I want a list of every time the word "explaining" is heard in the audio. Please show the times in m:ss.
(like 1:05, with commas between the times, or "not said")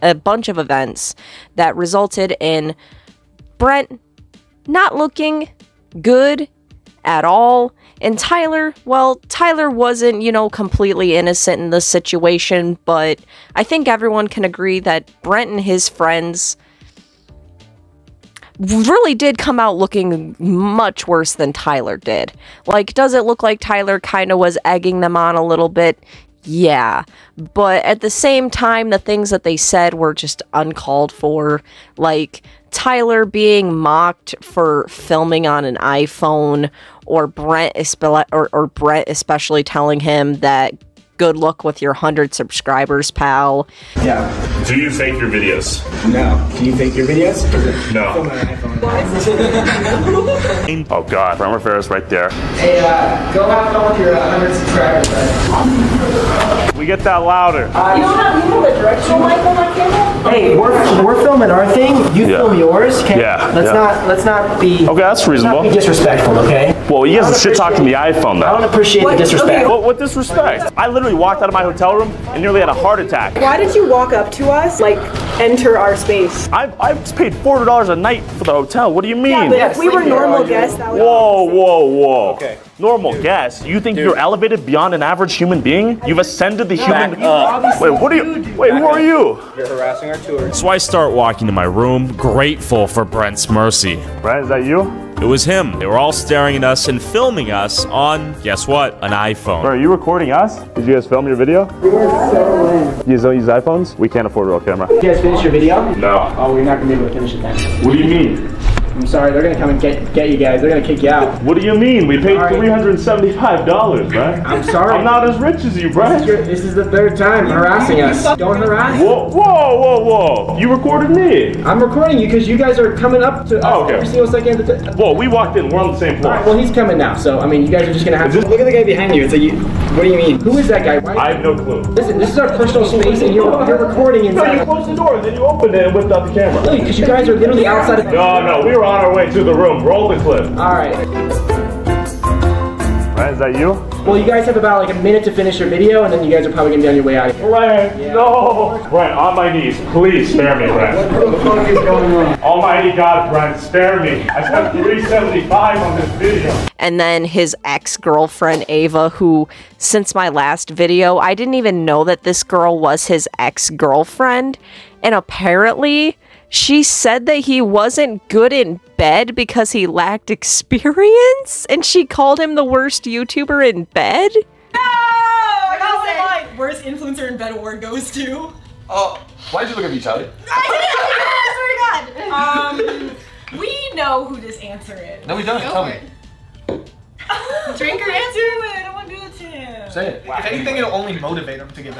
not said.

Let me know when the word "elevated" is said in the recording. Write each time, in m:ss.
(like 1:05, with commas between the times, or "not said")
1:24.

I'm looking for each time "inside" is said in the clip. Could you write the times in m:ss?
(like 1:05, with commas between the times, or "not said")
2:14.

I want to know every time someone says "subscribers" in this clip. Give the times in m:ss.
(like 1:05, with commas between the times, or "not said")
0:42, 0:56.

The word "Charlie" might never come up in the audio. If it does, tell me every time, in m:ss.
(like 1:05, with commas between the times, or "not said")
2:59.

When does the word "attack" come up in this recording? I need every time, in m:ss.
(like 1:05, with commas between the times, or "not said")
1:12.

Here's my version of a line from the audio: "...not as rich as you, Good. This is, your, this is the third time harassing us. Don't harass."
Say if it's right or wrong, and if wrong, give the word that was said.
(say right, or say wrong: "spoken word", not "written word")
wrong: "Brad", not "Good".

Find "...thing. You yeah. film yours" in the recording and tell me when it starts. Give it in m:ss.
1:01.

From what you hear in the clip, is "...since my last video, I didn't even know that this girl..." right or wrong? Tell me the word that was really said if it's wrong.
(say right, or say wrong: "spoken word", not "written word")
right.